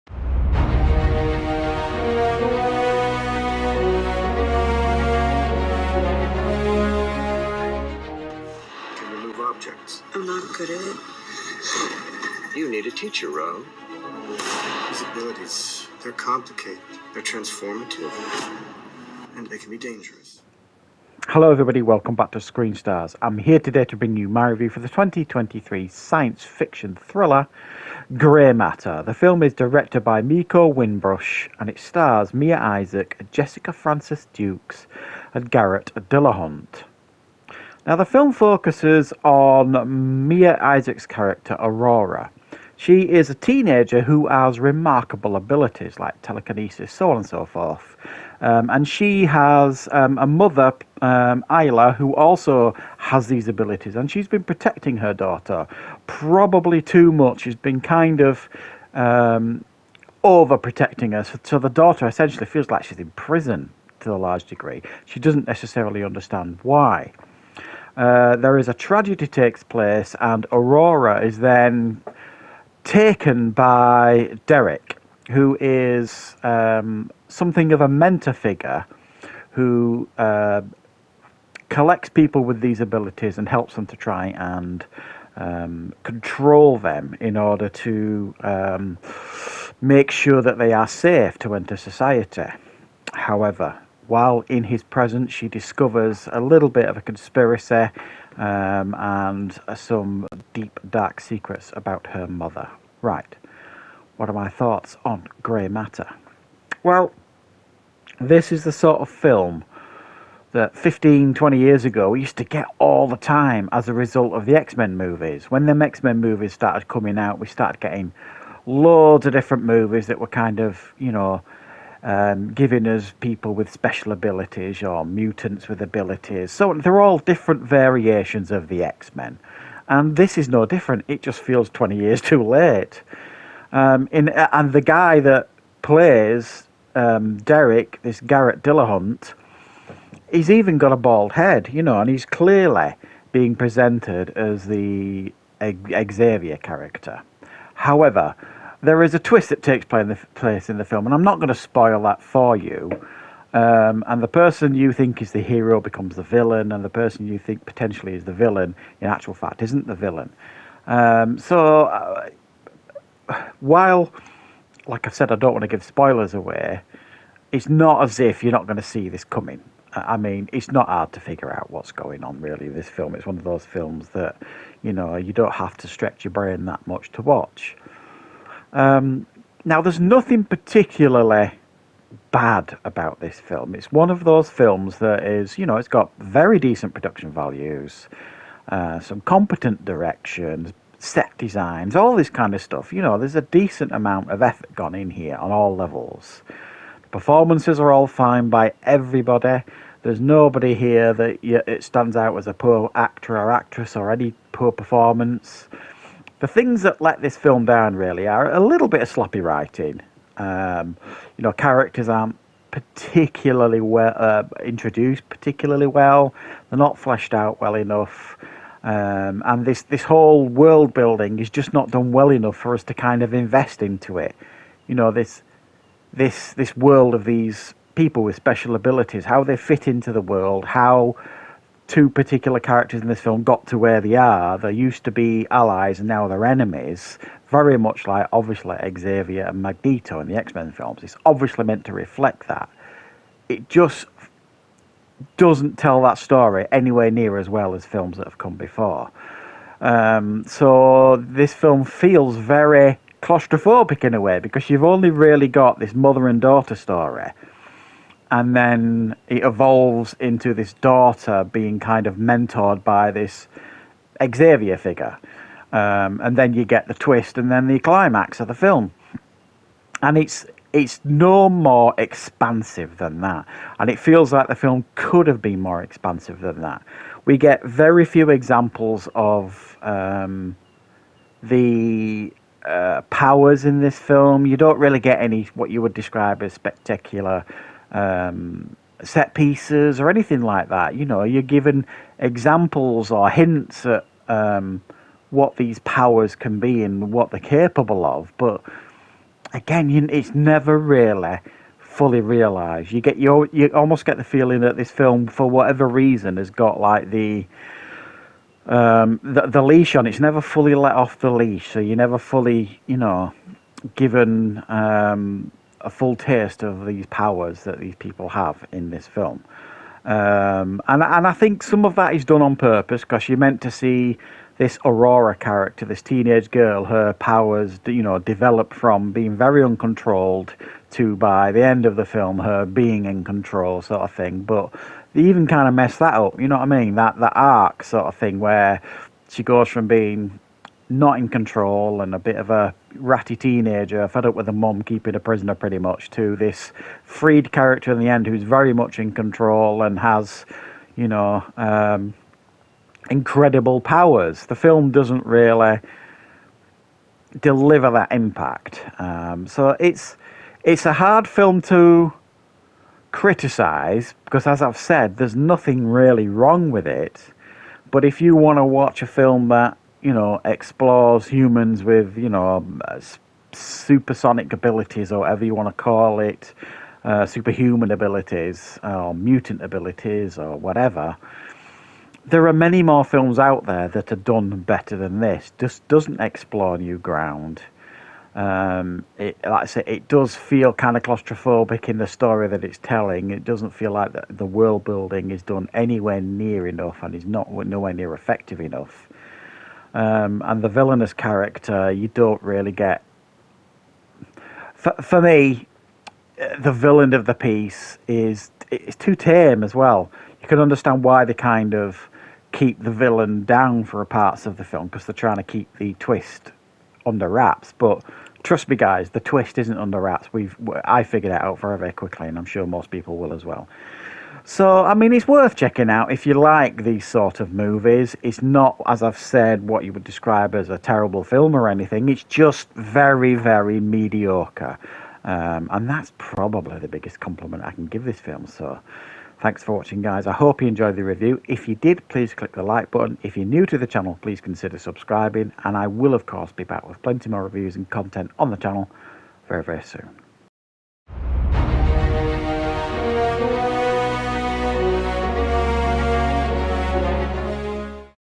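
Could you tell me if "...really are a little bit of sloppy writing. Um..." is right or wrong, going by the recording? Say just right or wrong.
right.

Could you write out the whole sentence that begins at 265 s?
Um, and then you get the twist and then the climax of the film.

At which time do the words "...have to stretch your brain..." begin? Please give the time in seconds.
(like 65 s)
175 s.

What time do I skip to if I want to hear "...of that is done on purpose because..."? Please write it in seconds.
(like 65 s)
321 s.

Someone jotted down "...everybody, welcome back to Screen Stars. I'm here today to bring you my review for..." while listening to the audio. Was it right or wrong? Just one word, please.
right.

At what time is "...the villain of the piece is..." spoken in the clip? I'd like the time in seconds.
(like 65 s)
406 s.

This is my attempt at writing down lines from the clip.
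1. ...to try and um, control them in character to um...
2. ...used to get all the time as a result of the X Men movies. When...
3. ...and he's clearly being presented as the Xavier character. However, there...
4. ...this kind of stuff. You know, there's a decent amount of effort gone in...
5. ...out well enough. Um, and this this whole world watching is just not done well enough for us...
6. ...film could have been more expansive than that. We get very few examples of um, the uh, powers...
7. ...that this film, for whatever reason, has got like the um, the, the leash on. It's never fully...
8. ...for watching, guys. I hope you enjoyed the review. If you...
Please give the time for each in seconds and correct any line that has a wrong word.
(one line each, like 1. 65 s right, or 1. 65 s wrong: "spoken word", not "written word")
1. 83 s wrong: "order", not "character"
2. 112 s right
3. 142 s right
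4. 192 s right
5. 217 s wrong: "building", not "watching"
6. 274 s right
7. 304 s right
8. 439 s right.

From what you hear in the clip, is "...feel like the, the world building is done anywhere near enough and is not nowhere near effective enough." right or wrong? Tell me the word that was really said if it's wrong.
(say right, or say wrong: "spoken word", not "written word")
right.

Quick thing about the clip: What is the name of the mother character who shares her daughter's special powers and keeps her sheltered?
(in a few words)
Isla.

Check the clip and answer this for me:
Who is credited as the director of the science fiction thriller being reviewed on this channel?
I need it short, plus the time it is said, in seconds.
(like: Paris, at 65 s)
Meko Winbush, at 30 s.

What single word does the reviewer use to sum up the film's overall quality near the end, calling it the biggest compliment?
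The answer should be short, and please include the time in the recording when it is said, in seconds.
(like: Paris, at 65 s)
mediocre, at 433 s.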